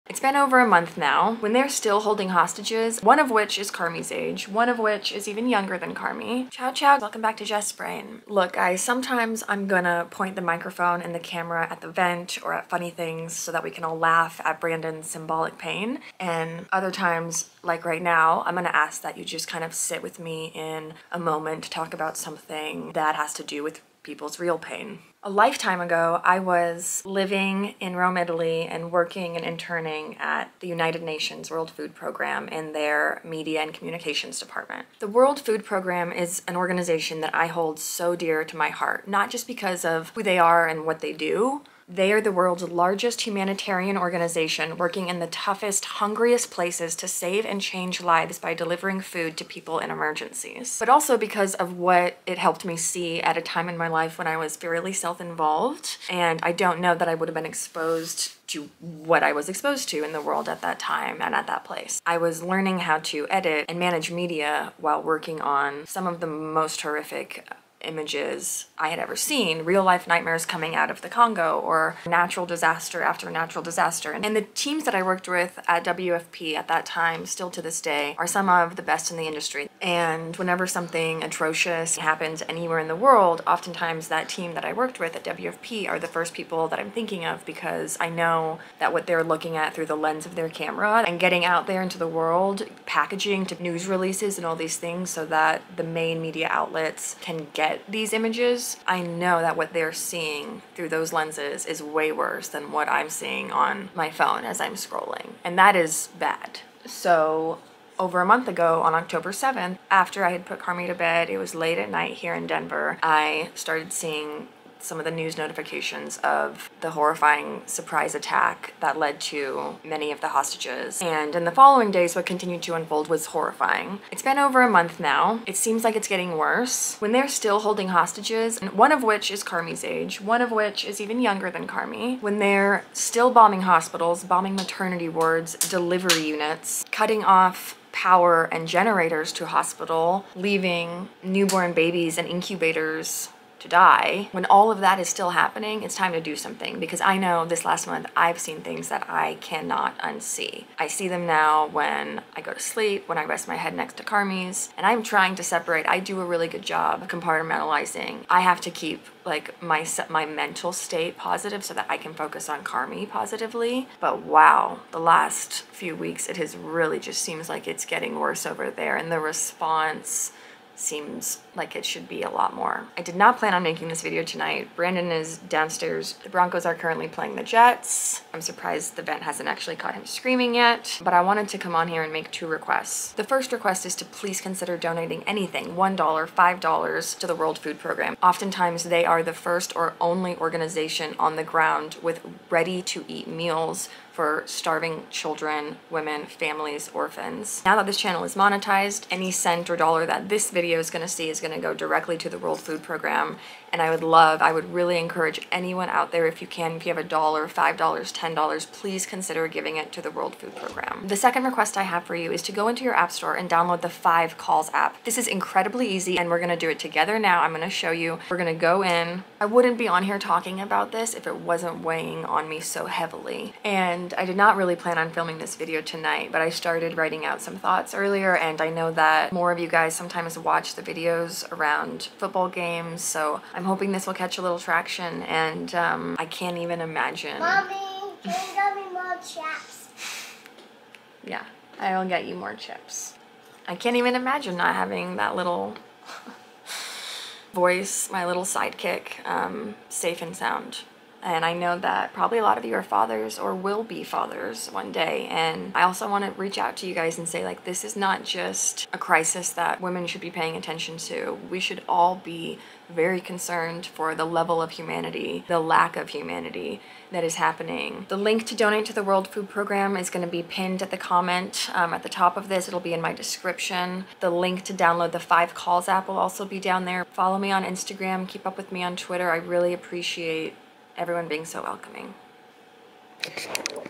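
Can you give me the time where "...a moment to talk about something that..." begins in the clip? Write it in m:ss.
0:21.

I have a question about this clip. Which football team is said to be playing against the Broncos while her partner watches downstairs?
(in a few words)
the Jets.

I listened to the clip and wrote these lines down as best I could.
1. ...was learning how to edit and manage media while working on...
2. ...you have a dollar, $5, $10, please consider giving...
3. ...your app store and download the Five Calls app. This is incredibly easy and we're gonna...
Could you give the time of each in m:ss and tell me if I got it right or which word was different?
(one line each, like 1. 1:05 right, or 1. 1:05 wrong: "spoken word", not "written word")
1. 1:02 right
2. 3:26 right
3. 3:32 right.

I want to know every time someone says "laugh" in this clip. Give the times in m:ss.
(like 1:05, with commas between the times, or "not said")
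0:13.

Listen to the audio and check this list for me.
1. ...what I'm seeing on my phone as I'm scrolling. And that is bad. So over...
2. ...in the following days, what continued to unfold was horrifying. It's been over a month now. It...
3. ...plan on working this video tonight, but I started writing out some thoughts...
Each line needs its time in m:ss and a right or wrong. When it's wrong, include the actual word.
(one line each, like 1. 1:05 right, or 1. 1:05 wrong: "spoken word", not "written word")
1. 1:42 right
2. 2:01 right
3. 3:44 wrong: "filming", not "working".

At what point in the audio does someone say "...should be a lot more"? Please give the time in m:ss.
2:51.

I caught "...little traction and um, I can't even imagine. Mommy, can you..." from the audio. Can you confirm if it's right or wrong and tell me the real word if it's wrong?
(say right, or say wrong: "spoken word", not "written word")
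right.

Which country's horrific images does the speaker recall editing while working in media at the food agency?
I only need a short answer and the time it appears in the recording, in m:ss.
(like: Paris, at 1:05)
Congo, at 1:11.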